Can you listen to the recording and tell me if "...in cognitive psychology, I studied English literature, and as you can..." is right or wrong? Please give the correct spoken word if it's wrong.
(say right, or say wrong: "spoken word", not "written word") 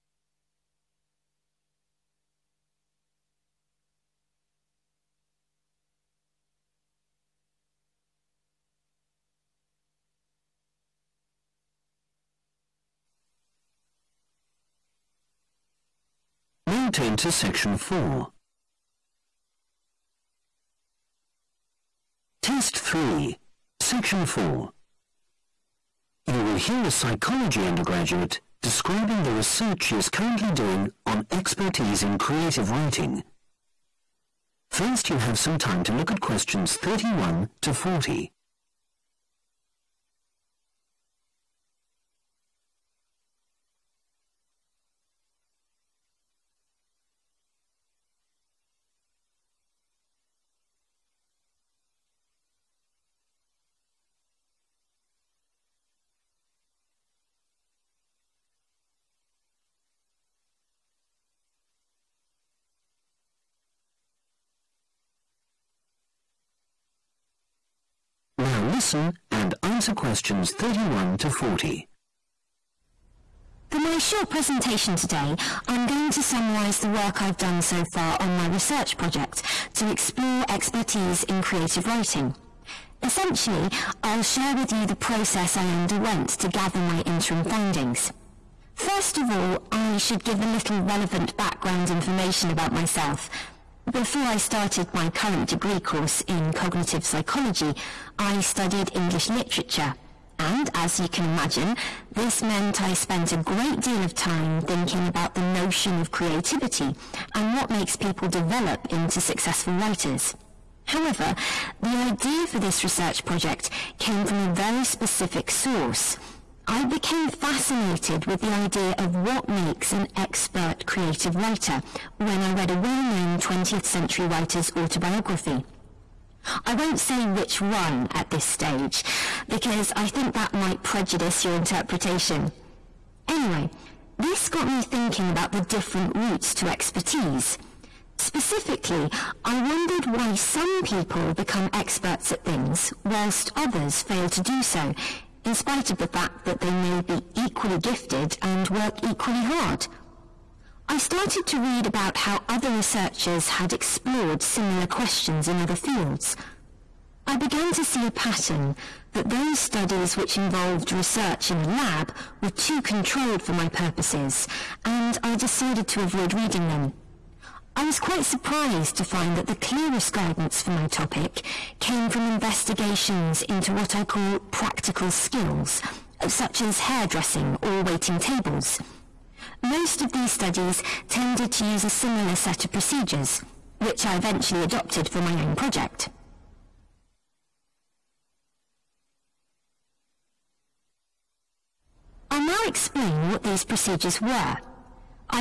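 right.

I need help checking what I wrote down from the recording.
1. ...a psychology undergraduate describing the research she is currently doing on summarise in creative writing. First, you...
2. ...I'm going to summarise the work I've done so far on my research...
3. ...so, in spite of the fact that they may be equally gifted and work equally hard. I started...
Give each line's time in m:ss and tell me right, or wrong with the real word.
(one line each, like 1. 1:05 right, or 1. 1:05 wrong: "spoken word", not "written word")
1. 0:26 wrong: "expertise", not "summarise"
2. 1:15 right
3. 2:24 right.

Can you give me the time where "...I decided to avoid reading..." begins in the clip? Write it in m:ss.
2:45.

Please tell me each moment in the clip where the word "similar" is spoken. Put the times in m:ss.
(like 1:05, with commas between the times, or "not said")
2:34, 3:01.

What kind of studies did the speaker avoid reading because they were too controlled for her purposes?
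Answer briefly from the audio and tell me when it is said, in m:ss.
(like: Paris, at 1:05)
research in a lab, at 2:40.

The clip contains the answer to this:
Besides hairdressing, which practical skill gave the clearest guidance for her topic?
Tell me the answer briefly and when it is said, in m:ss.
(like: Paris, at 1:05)
waiting tables, at 2:57.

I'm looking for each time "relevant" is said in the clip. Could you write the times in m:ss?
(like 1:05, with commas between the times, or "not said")
1:30.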